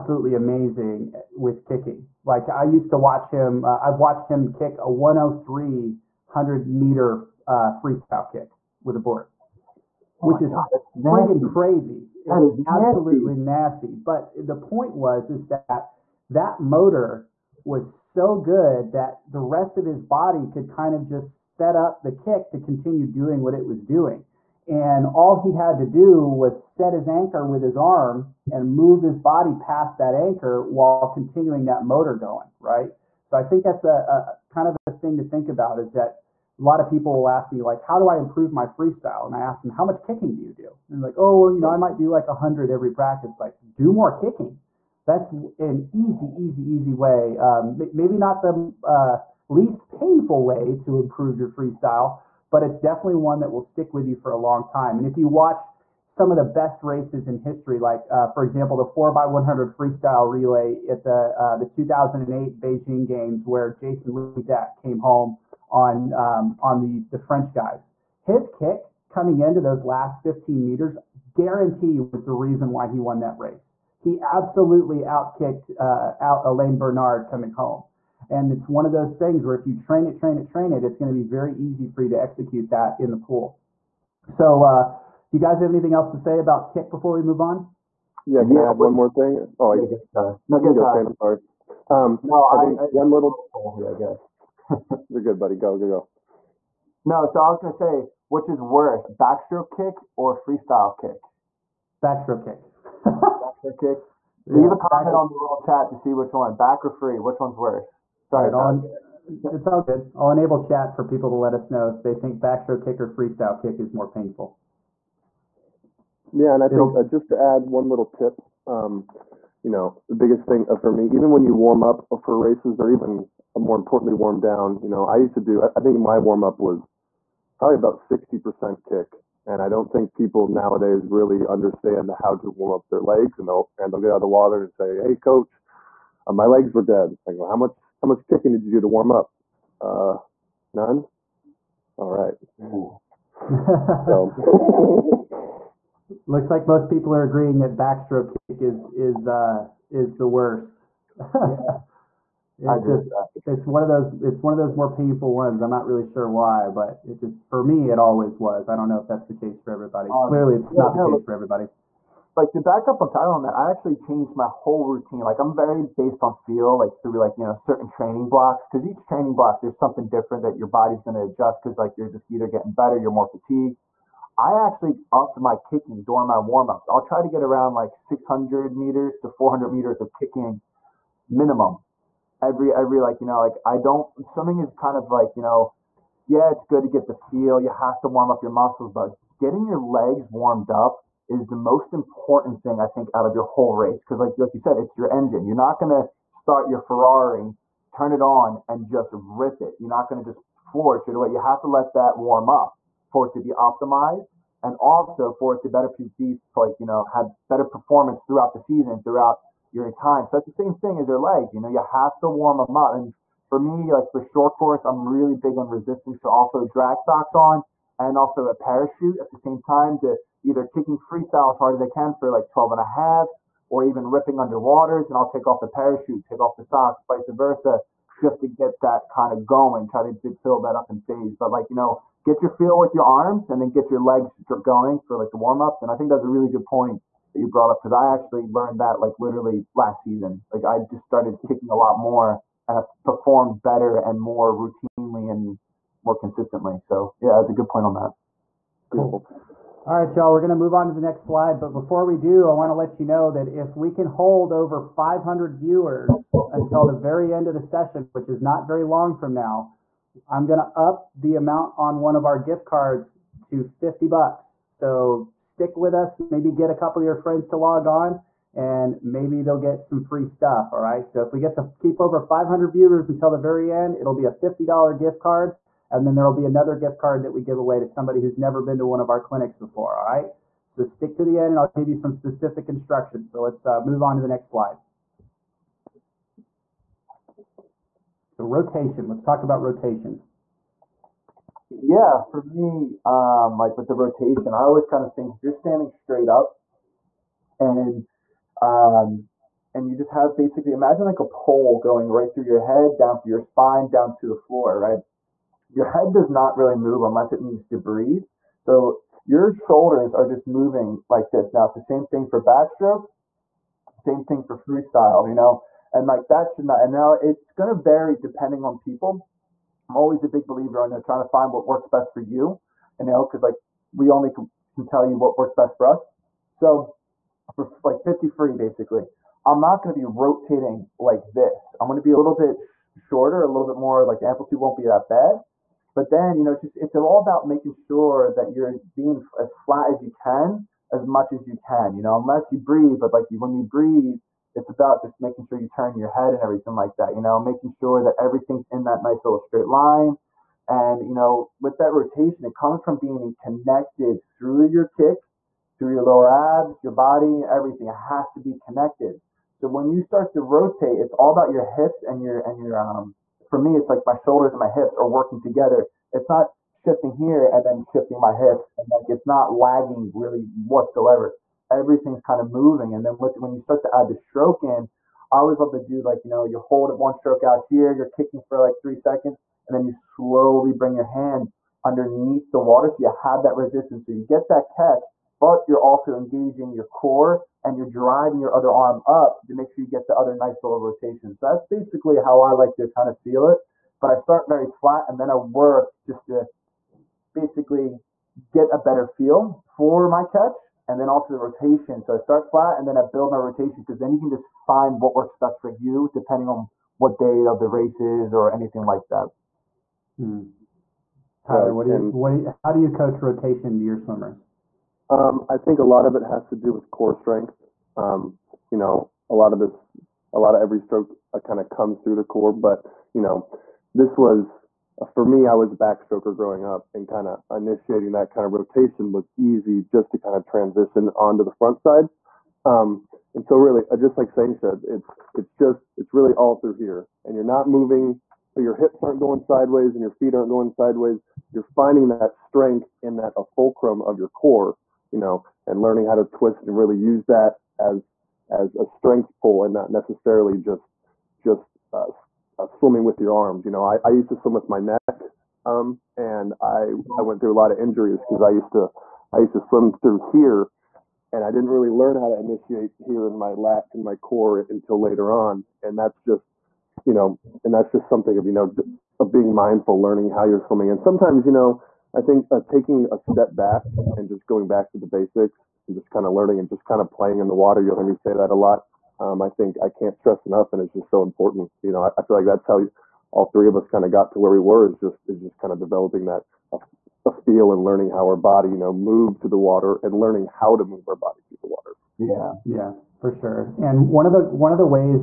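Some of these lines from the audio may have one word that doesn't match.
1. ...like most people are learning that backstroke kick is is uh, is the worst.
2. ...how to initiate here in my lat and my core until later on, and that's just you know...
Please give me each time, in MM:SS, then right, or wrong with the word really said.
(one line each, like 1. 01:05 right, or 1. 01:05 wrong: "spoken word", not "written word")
1. 02:26 wrong: "agreeing", not "learning"
2. 07:42 right.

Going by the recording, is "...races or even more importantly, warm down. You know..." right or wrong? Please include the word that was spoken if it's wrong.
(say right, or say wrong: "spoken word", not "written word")
right.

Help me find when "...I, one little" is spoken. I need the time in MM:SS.
01:32.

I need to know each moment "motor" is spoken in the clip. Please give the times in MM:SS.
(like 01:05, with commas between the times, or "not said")
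00:16, 00:31.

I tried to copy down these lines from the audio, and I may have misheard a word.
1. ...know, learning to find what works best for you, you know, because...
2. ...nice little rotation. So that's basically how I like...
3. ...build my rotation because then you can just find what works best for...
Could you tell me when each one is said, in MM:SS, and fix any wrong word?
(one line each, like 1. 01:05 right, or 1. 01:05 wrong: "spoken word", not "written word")
1. 05:20 wrong: "trying", not "learning"
2. 06:30 right
3. 06:43 right.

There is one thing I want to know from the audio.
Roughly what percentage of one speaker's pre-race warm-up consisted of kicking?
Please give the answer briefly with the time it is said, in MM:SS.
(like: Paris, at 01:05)
60%, at 02:08.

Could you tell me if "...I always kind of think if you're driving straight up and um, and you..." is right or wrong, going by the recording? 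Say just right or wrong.
wrong.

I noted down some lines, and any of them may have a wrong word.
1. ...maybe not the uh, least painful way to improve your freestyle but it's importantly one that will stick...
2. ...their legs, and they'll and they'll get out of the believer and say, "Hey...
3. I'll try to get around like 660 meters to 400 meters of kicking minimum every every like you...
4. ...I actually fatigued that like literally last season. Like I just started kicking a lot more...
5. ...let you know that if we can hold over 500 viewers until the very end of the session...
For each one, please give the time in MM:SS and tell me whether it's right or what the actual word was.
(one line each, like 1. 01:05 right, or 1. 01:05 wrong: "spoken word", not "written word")
1. 00:47 wrong: "definitely", not "importantly"
2. 02:12 wrong: "water", not "believer"
3. 02:56 wrong: "600", not "660"
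4. 03:57 wrong: "learned", not "fatigued"
5. 04:12 right.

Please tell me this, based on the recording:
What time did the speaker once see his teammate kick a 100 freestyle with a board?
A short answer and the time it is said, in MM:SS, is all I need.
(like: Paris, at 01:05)
103, at 00:04.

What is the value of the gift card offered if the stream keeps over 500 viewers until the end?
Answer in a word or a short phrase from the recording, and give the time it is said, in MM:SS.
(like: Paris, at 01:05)
$50, at 04:23.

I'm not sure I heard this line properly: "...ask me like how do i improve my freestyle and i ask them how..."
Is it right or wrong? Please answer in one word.
right.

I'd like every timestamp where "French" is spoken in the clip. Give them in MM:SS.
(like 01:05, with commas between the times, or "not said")
01:07.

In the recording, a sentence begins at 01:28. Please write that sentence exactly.
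Yeah, can yeah, I have one more thing?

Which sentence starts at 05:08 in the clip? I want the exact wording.
So your shoulders are just moving like this.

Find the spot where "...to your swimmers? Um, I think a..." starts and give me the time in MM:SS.
06:53.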